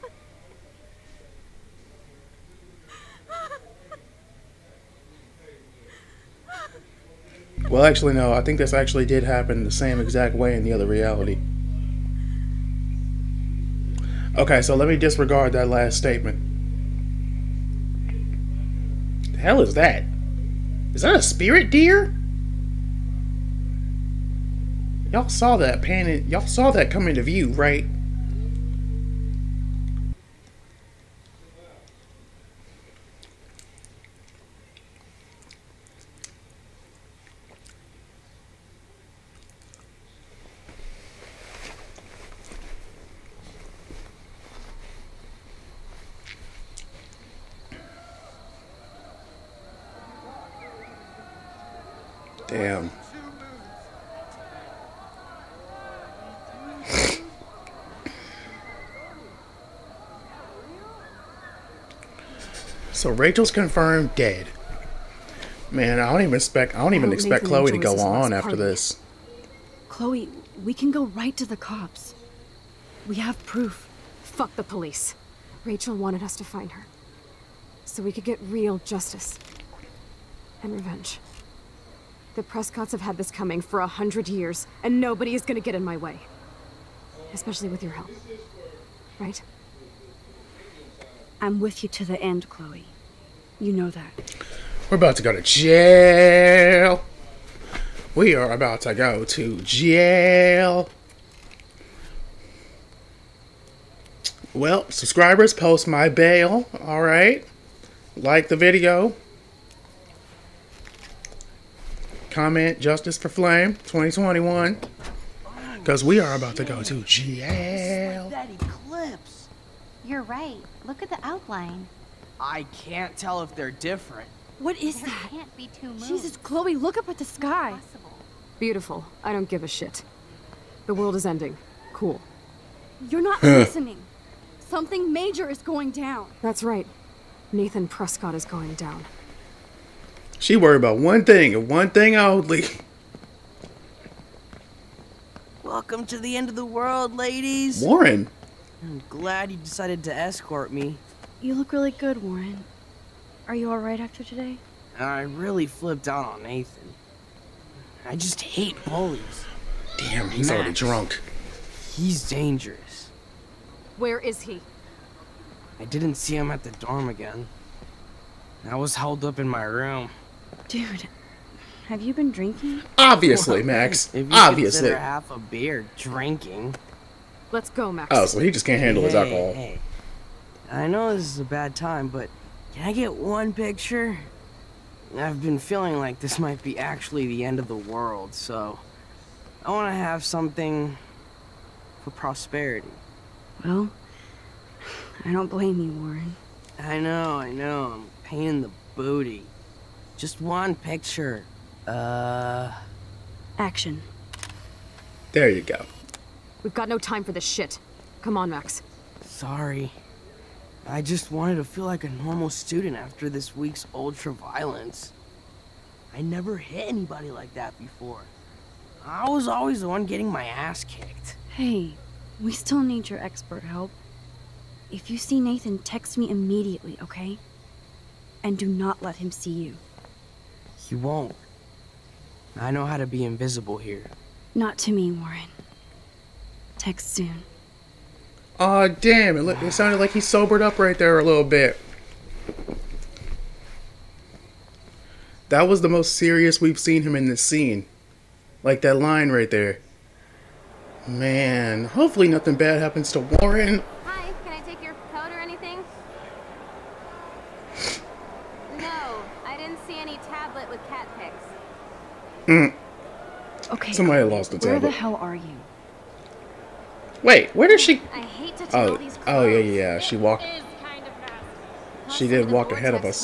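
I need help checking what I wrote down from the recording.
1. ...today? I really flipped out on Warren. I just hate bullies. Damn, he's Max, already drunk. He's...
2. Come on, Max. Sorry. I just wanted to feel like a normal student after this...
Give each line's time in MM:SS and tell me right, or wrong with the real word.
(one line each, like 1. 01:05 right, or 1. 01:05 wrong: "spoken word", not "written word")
1. 02:34 wrong: "Nathan", not "Warren"
2. 03:28 right.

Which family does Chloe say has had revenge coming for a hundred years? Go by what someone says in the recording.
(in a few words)
The Prescotts.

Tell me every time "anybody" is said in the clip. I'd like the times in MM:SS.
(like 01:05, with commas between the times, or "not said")
03:36.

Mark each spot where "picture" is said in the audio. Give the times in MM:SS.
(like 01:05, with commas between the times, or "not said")
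03:03, 03:20.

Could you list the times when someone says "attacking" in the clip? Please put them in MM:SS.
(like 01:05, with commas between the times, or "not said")
not said.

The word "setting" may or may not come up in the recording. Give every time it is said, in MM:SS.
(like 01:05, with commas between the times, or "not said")
not said.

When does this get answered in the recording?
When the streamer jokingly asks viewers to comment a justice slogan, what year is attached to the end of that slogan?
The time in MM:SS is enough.
01:53.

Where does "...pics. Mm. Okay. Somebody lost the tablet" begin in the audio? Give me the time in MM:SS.
04:21.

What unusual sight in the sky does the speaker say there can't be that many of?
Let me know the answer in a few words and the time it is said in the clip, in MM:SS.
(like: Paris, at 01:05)
Two moons, at 02:05.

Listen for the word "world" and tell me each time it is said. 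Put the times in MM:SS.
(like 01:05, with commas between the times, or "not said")
02:10, 02:26, 03:07.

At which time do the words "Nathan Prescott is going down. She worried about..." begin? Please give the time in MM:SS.
02:17.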